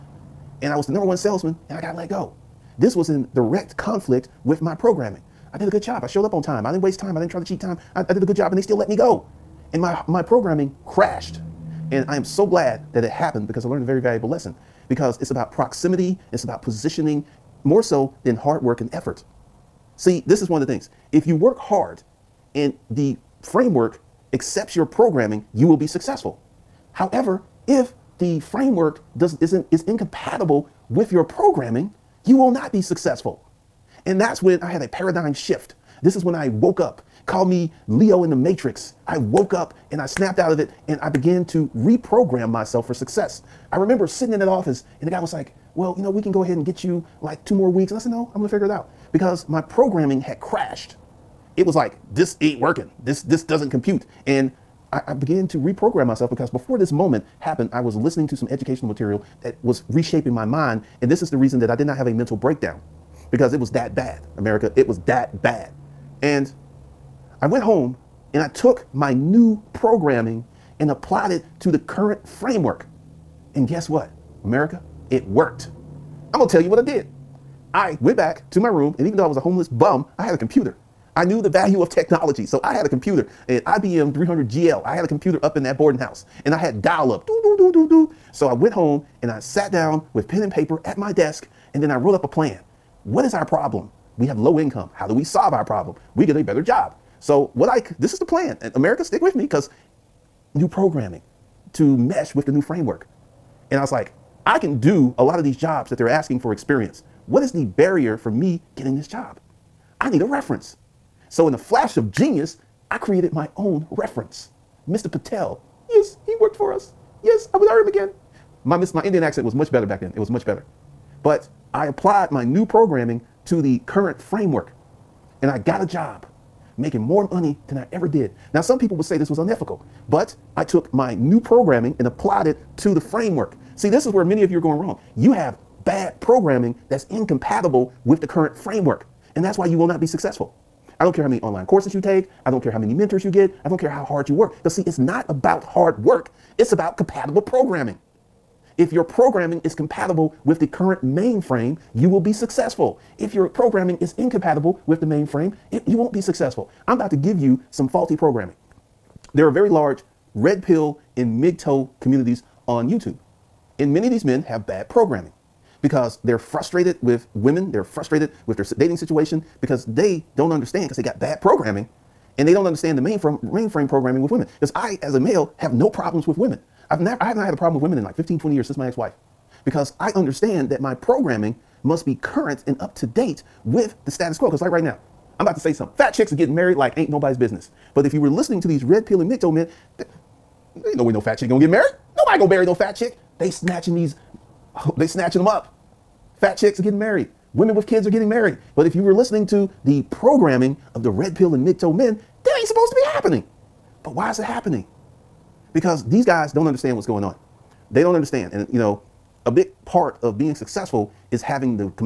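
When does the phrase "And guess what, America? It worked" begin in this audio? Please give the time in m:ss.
1:13.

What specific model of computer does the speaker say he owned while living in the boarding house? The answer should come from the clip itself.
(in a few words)
IBM 300GL.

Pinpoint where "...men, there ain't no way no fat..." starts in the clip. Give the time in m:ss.
3:09.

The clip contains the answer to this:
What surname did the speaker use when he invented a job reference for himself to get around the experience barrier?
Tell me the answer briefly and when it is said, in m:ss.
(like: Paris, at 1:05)
Patel, at 1:55.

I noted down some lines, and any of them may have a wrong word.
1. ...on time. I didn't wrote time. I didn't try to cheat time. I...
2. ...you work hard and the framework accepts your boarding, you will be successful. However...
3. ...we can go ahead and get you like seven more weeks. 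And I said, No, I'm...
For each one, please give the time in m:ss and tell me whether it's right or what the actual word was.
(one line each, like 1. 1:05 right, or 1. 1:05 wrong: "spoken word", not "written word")
1. 0:06 wrong: "waste", not "wrote"
2. 0:21 wrong: "programming", not "boarding"
3. 0:46 wrong: "two", not "seven".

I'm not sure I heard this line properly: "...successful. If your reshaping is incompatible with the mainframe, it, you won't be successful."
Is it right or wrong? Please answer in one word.
wrong.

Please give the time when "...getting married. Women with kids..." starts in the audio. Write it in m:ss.
3:16.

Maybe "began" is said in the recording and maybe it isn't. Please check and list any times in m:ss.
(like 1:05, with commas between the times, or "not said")
0:41, 0:55.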